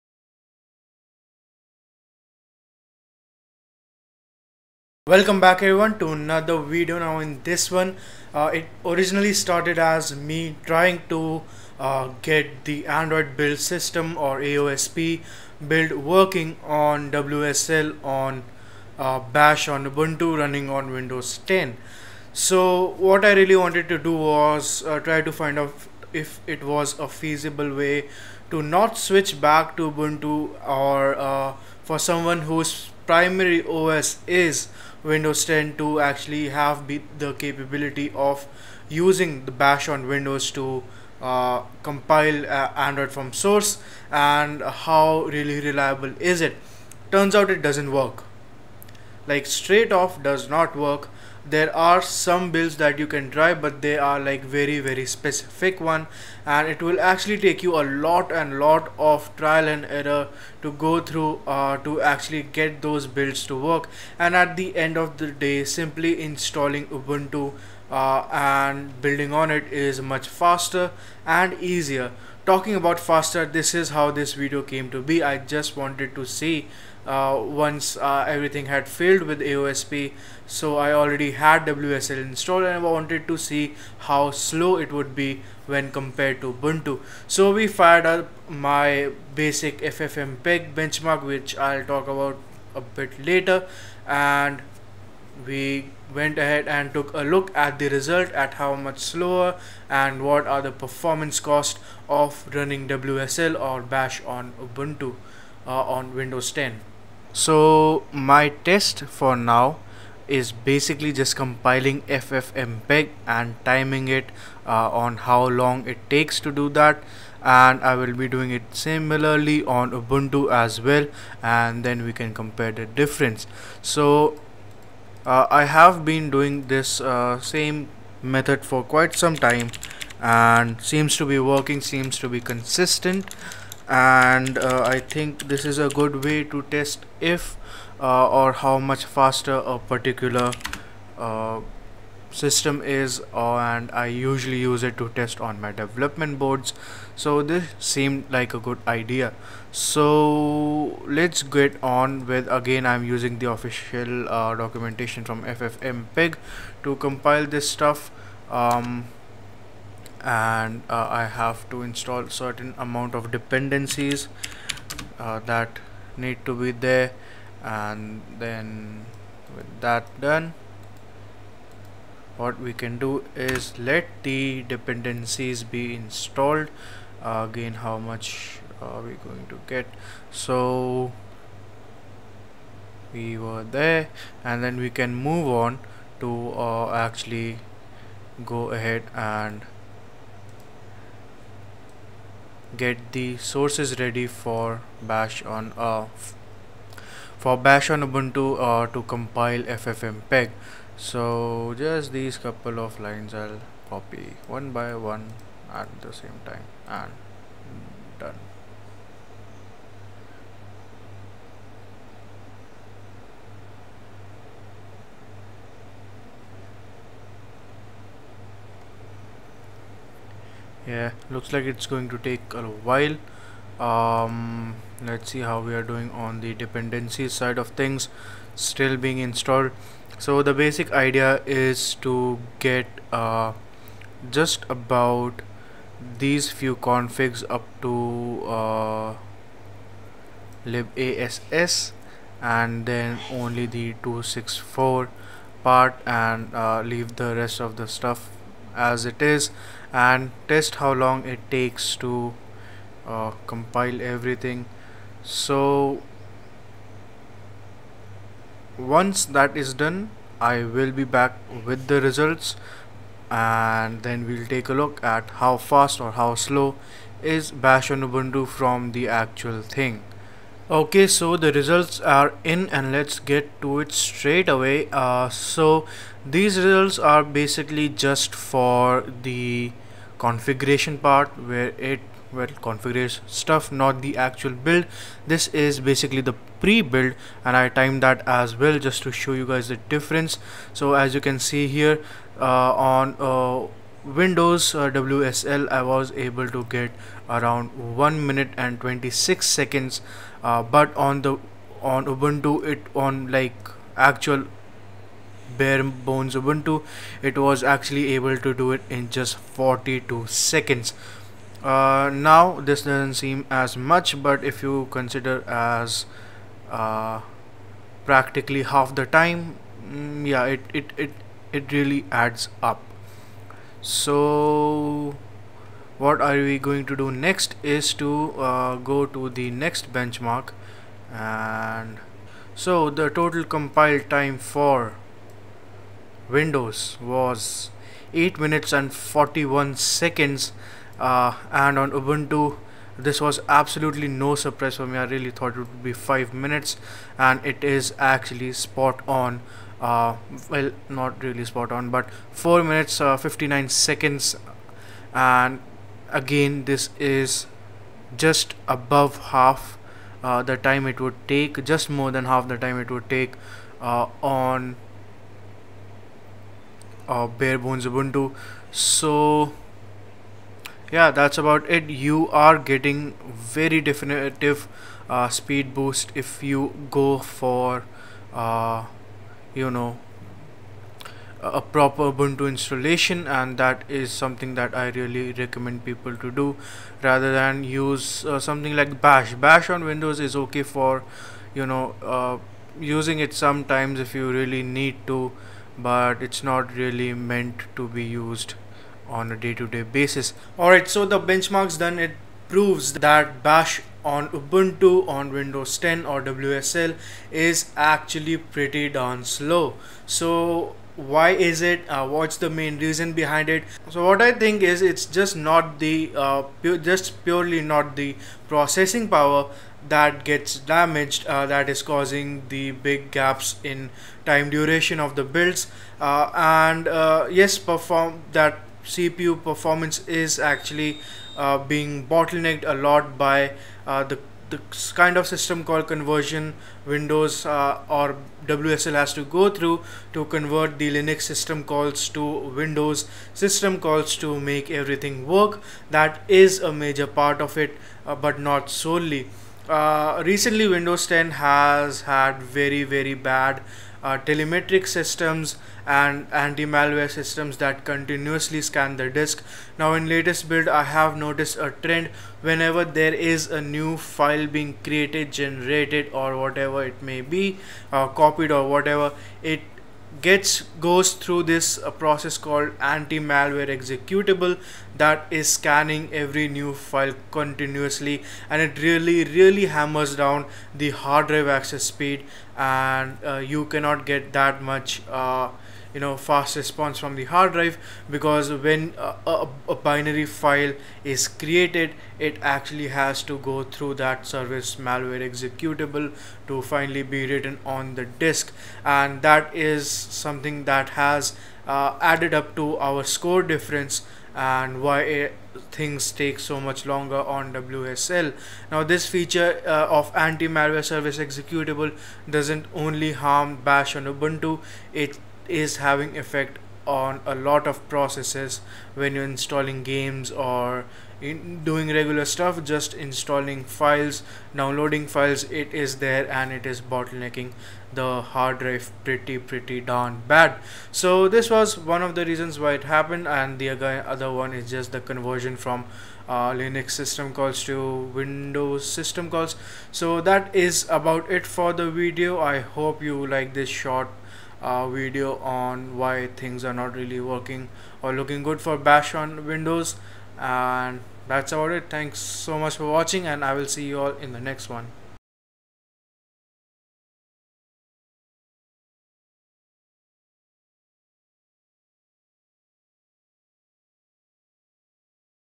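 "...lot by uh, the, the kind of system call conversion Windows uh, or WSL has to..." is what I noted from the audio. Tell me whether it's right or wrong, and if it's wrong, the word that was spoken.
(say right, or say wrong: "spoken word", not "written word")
right.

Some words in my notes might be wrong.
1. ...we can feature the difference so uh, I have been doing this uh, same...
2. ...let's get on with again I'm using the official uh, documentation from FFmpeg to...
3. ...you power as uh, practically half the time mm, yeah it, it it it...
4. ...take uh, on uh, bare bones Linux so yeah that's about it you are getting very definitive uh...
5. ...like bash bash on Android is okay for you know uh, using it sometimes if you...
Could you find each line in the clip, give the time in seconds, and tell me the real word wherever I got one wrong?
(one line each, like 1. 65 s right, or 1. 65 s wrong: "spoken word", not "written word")
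1. 122 s wrong: "compare", not "feature"
2. 151 s right
3. 314 s wrong: "consider", not "power"
4. 363 s wrong: "Ubuntu", not "Linux"
5. 388 s wrong: "Windows", not "Android".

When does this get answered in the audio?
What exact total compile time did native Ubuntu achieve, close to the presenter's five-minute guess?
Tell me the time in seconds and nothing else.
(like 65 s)
352 s.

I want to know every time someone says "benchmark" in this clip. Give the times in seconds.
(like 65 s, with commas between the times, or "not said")
90 s, 329 s, 401 s.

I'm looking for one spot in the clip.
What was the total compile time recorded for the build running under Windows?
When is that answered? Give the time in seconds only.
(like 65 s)
338 s.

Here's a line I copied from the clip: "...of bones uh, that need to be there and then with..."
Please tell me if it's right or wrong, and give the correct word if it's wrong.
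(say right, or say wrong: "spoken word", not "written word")
wrong: "dependencies", not "bones".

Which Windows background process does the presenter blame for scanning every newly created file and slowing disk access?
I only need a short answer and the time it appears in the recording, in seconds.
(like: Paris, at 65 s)
anti-malware executable, at 472 s.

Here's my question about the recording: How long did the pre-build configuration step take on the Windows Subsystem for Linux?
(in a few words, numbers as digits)
1 minute 26 seconds.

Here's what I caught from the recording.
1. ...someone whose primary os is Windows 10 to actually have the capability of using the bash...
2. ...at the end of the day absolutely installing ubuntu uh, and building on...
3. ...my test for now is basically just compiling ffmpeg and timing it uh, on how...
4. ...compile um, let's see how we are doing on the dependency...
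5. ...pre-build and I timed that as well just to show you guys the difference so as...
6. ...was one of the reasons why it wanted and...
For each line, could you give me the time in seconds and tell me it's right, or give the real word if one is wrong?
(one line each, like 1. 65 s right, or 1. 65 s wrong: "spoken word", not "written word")
1. 31 s right
2. 64 s wrong: "simply", not "absolutely"
3. 108 s right
4. 222 s wrong: "while", not "compile"
5. 286 s right
6. 531 s wrong: "happened", not "wanted".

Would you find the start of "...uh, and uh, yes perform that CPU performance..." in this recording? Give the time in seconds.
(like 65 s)
426 s.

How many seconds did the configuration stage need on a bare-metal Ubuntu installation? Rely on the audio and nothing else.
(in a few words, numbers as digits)
42 seconds.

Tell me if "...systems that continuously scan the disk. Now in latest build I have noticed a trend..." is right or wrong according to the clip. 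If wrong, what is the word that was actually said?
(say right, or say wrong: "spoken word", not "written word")
right.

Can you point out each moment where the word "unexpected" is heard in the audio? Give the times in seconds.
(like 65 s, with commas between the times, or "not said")
not said.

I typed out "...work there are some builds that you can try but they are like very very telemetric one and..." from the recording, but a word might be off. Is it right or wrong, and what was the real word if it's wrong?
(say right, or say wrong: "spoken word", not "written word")
wrong: "specific", not "telemetric".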